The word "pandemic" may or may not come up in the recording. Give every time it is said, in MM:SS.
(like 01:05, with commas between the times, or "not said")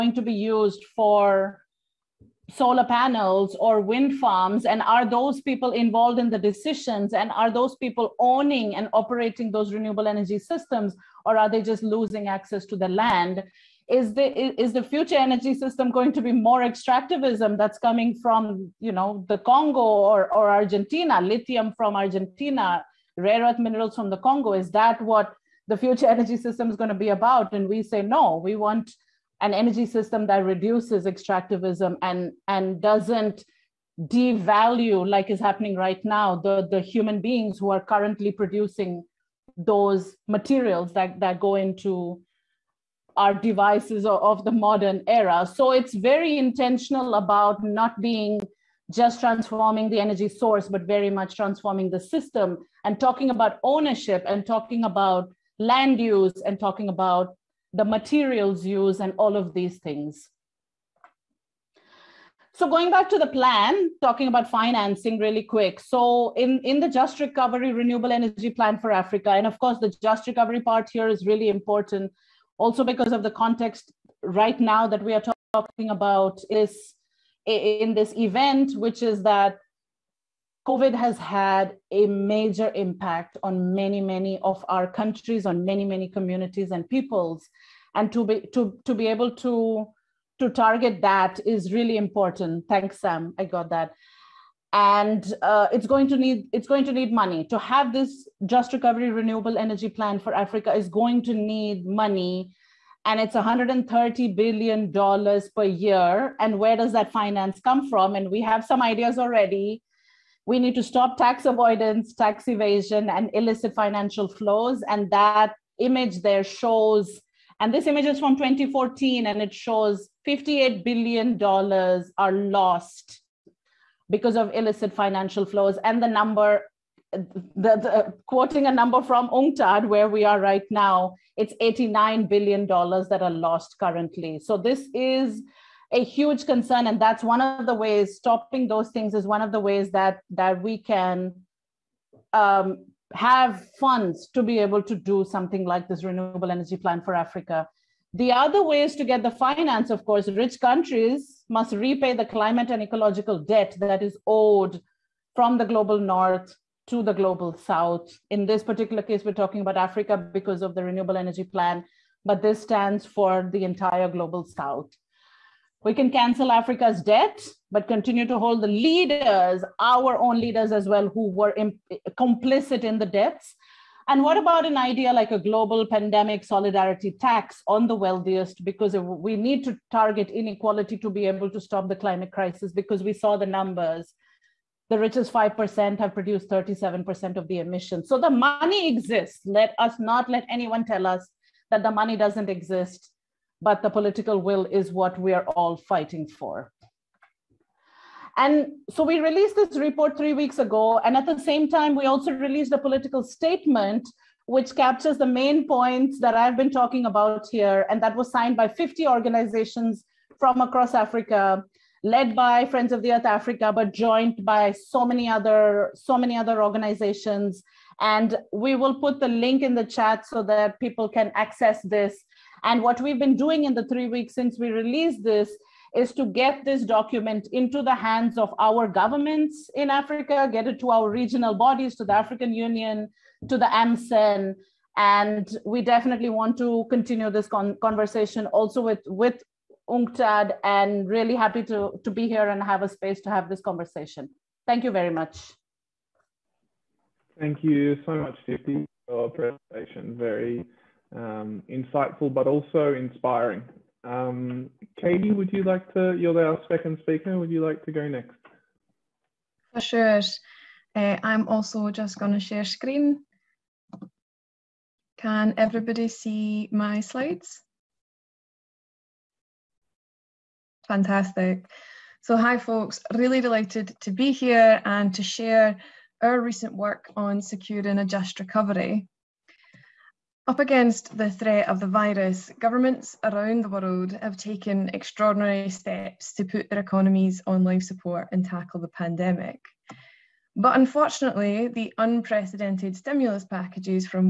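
02:55, 04:48.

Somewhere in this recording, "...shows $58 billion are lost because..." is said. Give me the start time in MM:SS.
01:59.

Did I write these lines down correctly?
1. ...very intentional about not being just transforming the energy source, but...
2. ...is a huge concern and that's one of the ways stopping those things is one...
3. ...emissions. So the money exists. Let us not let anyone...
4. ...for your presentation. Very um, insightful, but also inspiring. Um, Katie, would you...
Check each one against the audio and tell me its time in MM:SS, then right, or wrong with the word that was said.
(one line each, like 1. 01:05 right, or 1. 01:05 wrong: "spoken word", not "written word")
1. 00:45 right
2. 02:14 right
3. 03:07 right
4. 04:09 right.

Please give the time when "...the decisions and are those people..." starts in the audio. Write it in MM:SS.
00:06.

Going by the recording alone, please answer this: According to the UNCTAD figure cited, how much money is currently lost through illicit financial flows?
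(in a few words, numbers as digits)
$89 billion.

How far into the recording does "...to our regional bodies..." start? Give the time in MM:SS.
03:50.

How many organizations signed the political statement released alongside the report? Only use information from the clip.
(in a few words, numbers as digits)
50.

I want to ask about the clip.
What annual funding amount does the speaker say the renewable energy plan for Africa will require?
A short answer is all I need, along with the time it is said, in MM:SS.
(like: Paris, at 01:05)
$130 billion per year, at 01:43.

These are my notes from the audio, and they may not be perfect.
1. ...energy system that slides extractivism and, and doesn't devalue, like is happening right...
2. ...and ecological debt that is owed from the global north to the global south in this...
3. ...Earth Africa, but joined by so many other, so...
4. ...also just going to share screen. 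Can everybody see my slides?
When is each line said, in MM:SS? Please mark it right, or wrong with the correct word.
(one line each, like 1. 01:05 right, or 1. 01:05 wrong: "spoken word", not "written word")
1. 00:29 wrong: "reduces", not "slides"
2. 02:32 right
3. 03:33 right
4. 04:21 right.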